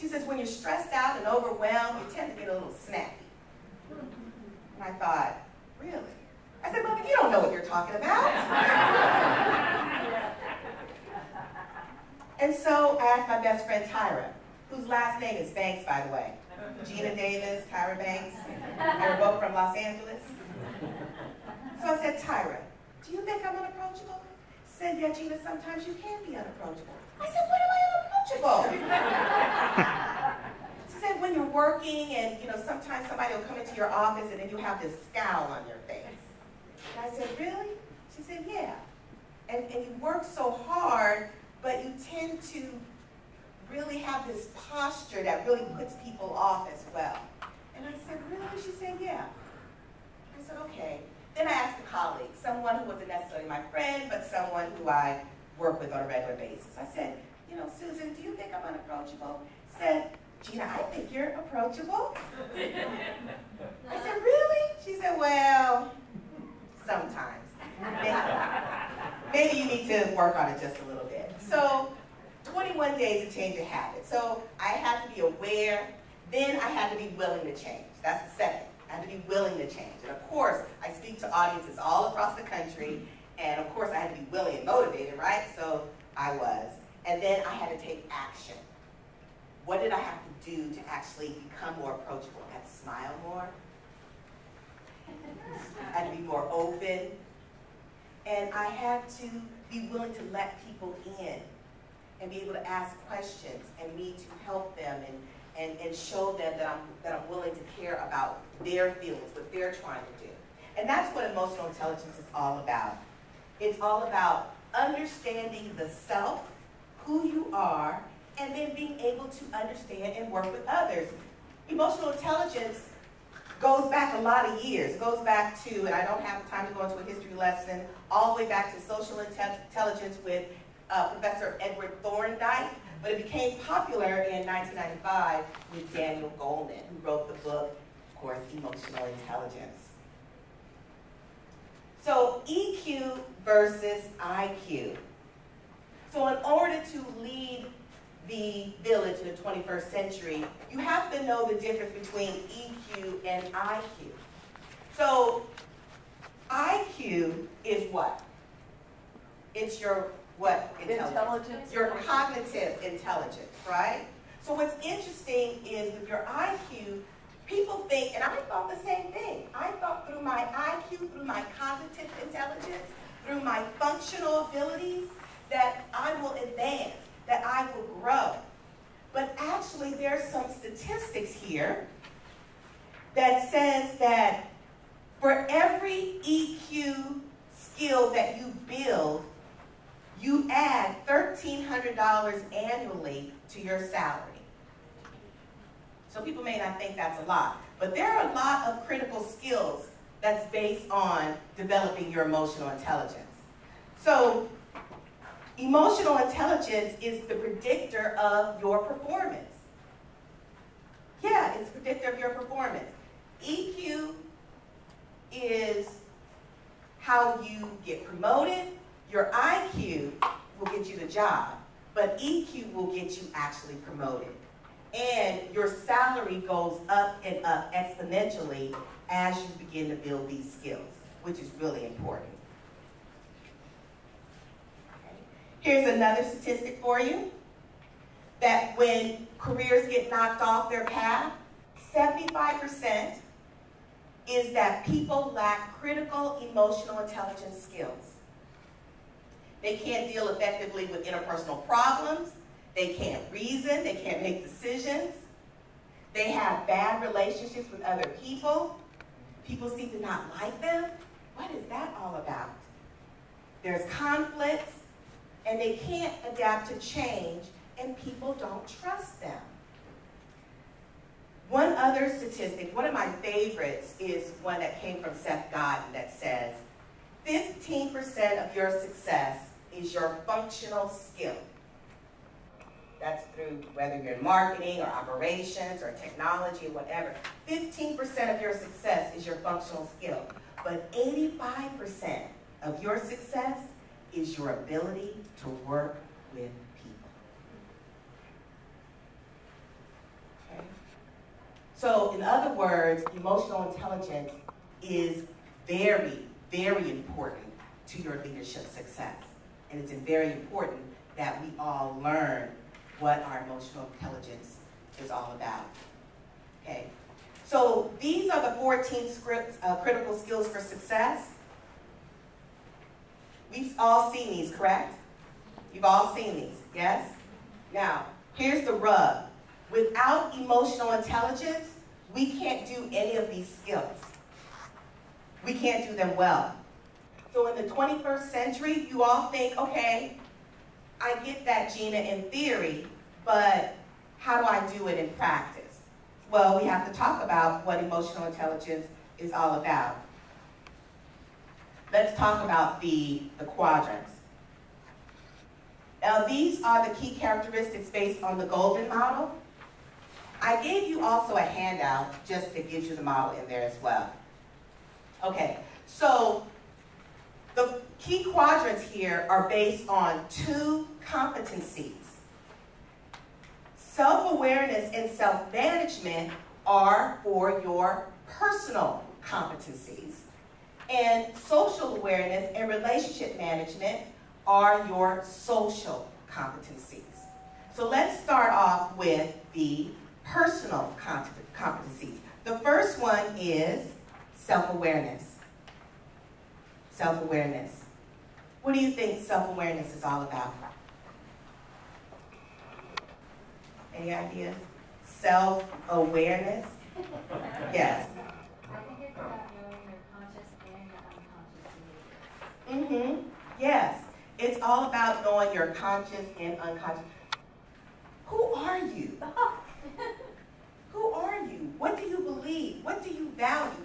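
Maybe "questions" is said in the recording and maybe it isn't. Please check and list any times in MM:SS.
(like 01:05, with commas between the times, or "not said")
01:43.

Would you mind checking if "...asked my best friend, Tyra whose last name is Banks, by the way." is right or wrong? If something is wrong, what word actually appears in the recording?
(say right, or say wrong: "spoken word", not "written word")
right.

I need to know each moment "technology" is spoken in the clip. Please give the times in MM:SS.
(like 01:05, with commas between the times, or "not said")
04:45.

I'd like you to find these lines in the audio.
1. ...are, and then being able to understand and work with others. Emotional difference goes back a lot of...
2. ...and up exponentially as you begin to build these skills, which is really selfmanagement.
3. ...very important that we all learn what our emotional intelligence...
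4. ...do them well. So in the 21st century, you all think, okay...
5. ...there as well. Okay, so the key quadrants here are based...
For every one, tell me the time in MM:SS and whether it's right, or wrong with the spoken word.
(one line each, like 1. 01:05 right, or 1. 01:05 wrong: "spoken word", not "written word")
1. 01:57 wrong: "intelligence", not "difference"
2. 03:47 wrong: "important", not "selfmanagement"
3. 05:09 right
4. 05:35 right
5. 06:03 right.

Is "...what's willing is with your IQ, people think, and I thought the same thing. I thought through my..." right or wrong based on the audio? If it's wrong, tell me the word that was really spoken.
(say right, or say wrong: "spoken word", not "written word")
wrong: "interesting", not "willing".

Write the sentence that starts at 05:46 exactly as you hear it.
Well, we have to talk about what emotional intelligence is all about.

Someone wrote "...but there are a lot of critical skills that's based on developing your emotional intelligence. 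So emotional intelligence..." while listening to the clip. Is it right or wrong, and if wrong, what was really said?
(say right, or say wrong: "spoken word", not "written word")
right.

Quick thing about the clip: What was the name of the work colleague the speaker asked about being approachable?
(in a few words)
Susan.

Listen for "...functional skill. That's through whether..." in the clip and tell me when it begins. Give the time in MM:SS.
04:40.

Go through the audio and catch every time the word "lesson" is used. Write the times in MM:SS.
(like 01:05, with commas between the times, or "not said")
02:07.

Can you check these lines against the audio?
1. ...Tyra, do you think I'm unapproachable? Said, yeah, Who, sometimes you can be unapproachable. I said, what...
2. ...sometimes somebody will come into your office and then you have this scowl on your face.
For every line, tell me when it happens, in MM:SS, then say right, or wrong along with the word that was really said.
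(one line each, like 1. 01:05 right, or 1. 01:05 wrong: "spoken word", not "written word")
1. 00:22 wrong: "Gena", not "Who"
2. 00:32 right.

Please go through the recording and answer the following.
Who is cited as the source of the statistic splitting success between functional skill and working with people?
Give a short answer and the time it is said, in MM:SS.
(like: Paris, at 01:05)
Seth Godin, at 04:35.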